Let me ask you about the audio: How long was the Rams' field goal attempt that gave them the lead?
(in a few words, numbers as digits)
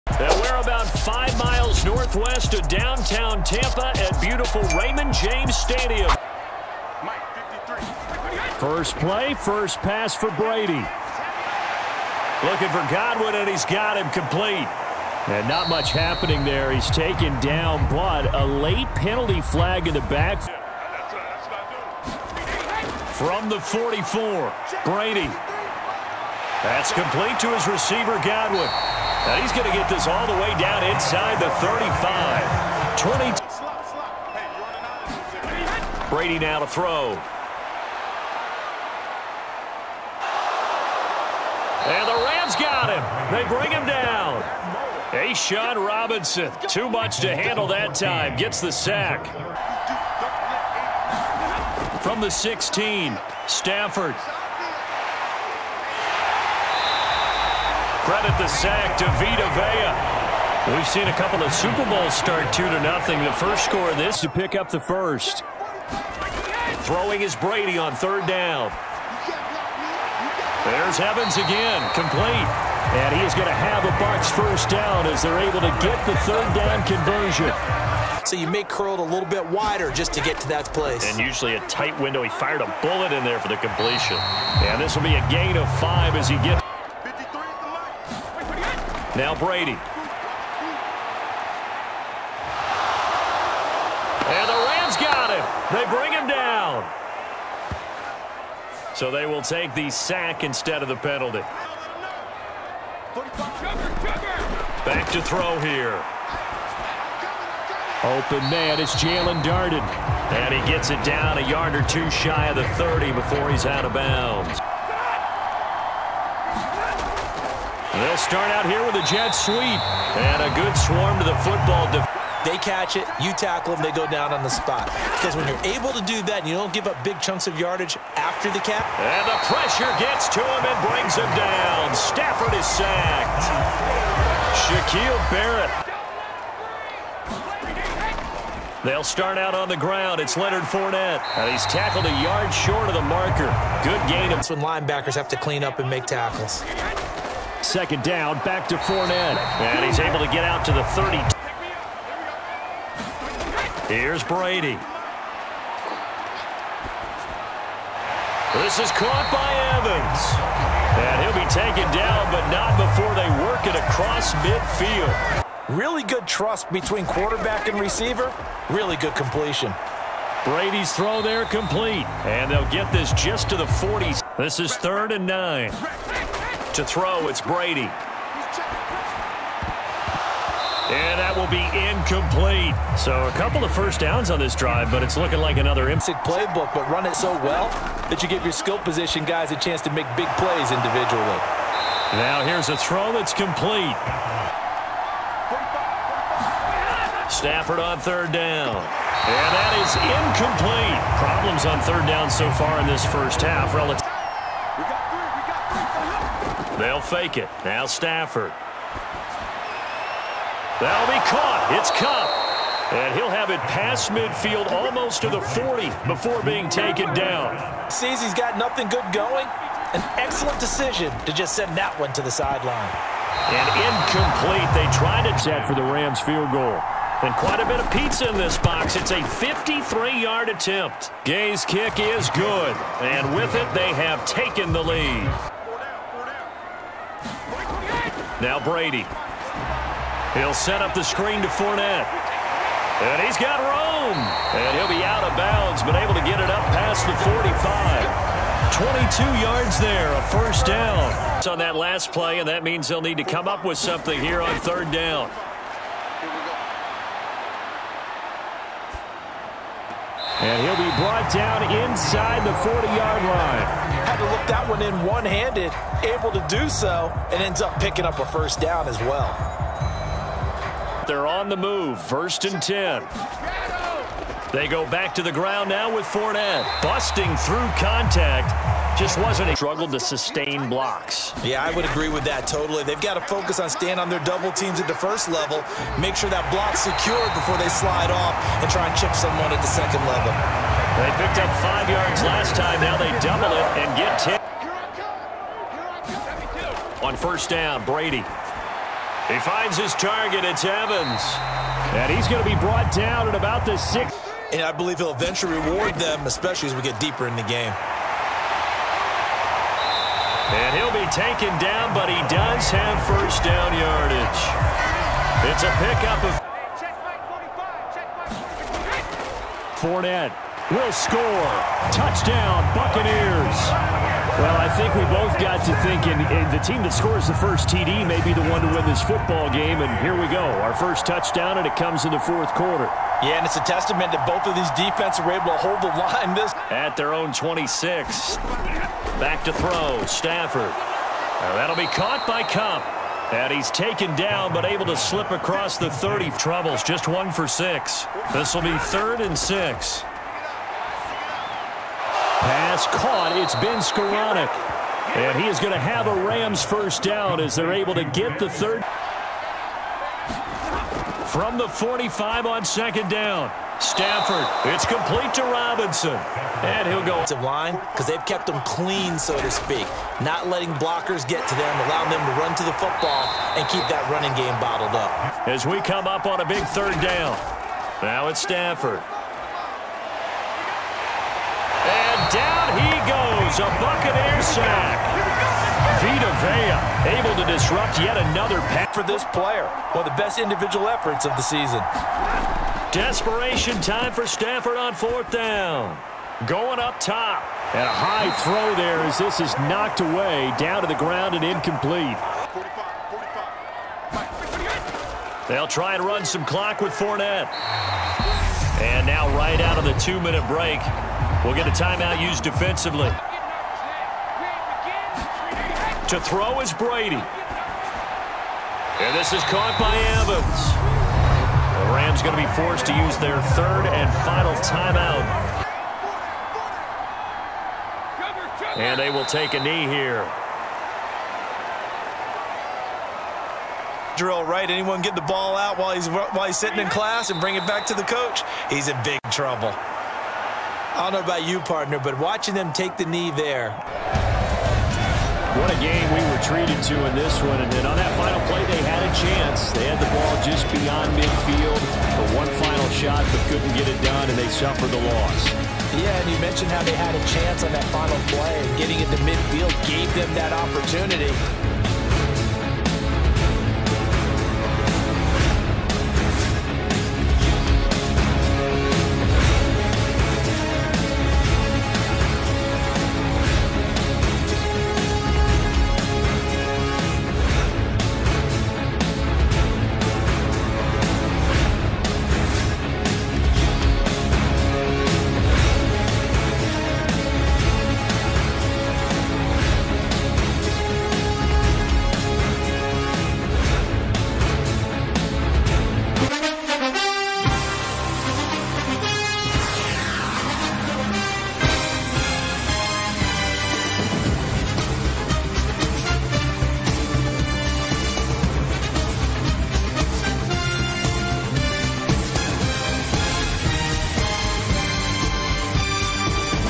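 53 yards.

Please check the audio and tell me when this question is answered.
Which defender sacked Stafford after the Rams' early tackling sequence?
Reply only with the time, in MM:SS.
02:14.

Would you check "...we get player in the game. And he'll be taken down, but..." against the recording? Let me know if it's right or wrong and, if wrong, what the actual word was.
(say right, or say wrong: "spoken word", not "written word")
wrong: "deeper", not "player".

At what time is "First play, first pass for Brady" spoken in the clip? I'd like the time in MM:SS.
00:08.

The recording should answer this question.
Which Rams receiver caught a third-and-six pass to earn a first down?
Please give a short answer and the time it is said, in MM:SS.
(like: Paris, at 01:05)
Ben Skowronek, at 05:53.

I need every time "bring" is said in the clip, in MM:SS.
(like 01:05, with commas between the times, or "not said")
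00:43, 01:35, 02:10, 07:17.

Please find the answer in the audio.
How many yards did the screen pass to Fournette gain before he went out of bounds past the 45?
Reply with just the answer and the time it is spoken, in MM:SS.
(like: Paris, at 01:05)
22, at 04:08.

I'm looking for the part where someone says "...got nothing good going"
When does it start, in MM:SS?
03:38.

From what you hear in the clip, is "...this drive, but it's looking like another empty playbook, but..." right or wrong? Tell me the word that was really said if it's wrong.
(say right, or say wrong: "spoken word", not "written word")
right.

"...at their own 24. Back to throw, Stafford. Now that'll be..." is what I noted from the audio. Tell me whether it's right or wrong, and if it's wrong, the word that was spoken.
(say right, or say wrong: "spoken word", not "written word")
wrong: "26", not "24".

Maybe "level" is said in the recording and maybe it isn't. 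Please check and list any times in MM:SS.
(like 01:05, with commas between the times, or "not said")
04:45, 04:50.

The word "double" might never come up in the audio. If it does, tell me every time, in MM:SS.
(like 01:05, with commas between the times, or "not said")
04:44, 04:53.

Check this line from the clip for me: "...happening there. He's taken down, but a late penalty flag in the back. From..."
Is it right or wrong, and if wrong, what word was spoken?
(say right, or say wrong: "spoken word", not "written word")
right.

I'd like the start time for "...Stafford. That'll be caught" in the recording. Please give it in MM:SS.
03:27.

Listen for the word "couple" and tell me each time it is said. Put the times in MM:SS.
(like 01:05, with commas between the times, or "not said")
01:01, 03:03.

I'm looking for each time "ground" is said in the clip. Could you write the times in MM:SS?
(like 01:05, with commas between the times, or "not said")
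02:19, 04:35, 06:40.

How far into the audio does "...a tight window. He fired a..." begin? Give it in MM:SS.
01:21.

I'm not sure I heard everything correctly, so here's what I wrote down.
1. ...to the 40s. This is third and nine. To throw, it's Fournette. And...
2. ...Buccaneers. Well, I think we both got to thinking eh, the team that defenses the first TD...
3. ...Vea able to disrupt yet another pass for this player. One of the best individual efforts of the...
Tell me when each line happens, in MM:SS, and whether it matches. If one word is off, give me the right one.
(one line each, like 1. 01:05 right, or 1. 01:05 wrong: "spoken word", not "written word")
1. 02:53 wrong: "Brady", not "Fournette"
2. 05:22 wrong: "scores", not "defenses"
3. 06:26 right.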